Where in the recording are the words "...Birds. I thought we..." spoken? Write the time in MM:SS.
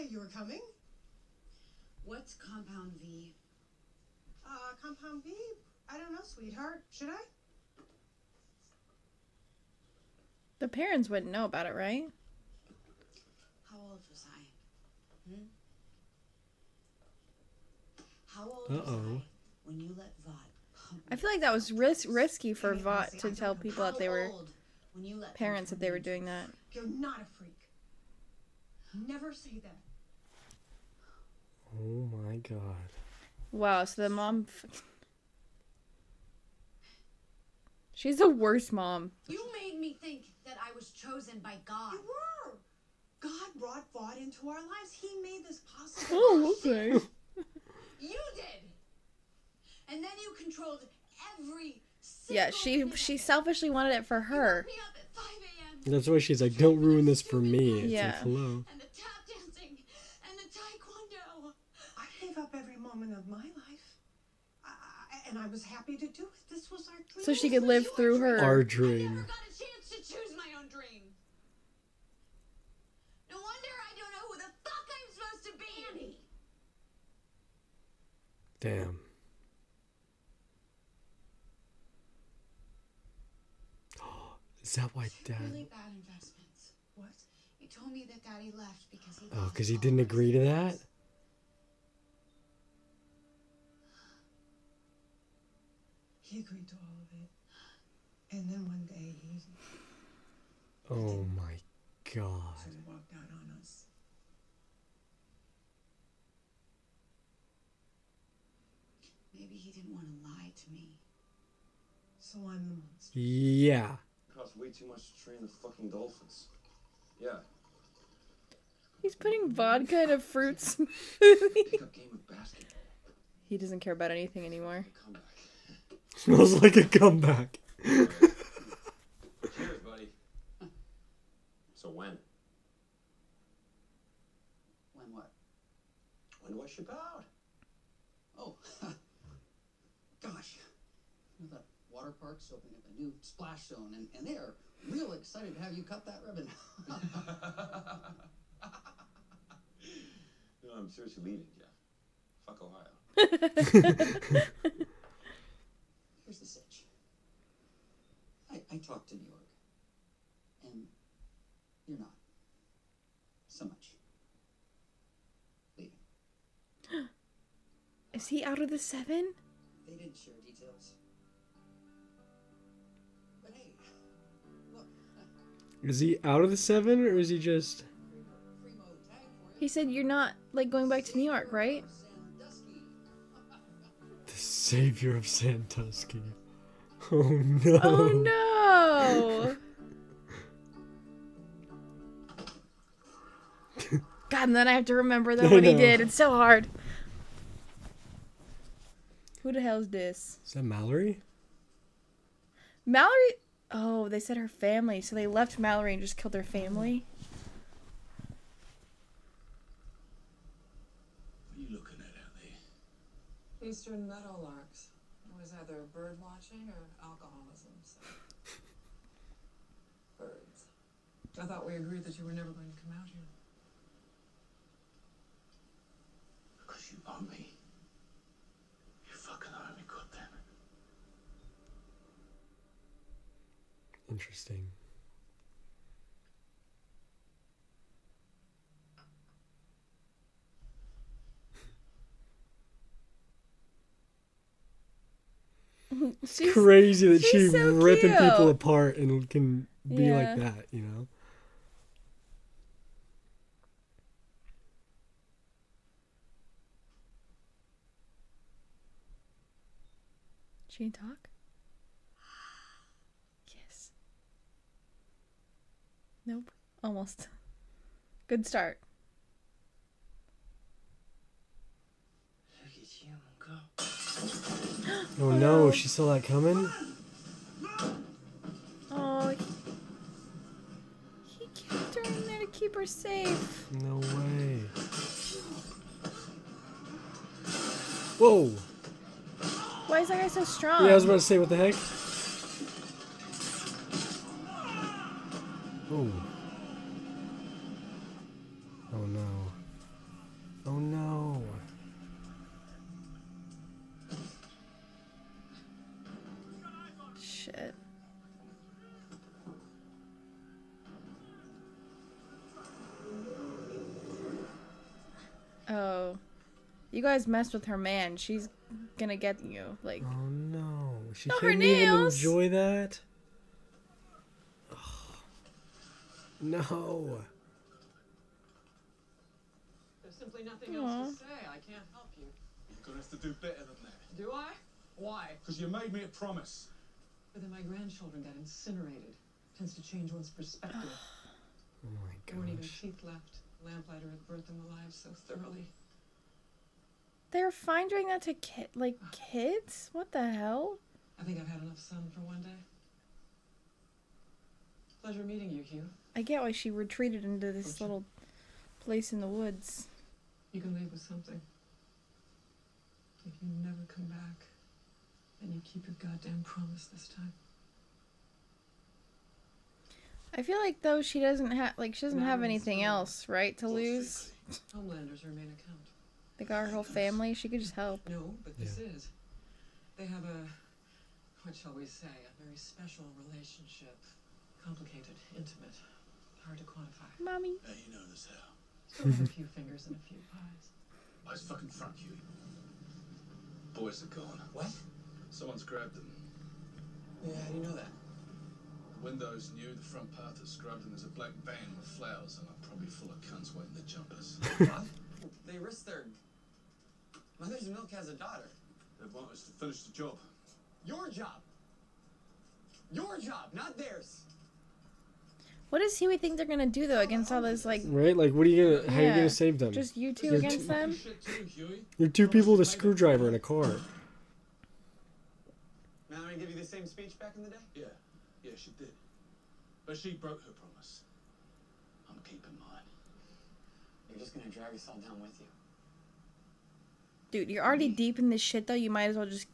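03:40.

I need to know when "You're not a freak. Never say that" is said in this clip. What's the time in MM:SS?
00:26.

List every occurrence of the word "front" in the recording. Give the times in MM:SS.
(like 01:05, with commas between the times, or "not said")
06:31, 06:39.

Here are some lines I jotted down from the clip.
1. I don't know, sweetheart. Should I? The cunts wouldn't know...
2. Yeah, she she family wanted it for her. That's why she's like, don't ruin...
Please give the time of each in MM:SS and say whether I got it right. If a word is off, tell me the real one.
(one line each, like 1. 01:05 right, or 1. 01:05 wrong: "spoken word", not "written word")
1. 00:05 wrong: "parents", not "cunts"
2. 00:52 wrong: "selfishly", not "family".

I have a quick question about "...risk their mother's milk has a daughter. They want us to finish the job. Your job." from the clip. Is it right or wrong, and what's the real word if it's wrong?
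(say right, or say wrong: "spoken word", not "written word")
right.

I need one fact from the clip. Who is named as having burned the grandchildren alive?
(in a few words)
Lamplighter.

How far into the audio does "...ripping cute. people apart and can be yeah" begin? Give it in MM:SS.
04:07.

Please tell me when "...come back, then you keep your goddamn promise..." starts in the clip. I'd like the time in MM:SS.
06:03.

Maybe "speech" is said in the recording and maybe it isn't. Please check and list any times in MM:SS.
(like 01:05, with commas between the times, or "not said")
07:06.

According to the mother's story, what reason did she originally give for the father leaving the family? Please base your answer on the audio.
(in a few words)
Really bad investments.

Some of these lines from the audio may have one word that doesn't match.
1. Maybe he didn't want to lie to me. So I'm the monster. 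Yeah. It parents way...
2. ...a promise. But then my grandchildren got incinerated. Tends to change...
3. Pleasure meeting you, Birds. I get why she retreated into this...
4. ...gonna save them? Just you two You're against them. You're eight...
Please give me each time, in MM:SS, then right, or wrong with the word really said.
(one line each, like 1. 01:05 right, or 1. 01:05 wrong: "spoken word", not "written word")
1. 01:49 wrong: "costs", not "parents"
2. 05:36 right
3. 05:55 wrong: "Hugh", not "Birds"
4. 06:59 wrong: "two", not "eight".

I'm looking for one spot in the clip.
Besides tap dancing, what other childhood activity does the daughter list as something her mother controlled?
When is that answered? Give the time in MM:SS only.
01:00.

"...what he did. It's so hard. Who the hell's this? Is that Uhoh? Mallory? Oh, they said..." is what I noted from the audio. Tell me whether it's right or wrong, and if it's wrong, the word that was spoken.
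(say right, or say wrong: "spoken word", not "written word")
wrong: "Mallory", not "Uhoh".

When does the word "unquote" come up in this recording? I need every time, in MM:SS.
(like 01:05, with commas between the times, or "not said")
not said.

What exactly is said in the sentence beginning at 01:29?
Oh, because he didn't agree to that.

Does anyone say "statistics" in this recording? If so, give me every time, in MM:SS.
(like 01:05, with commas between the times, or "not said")
not said.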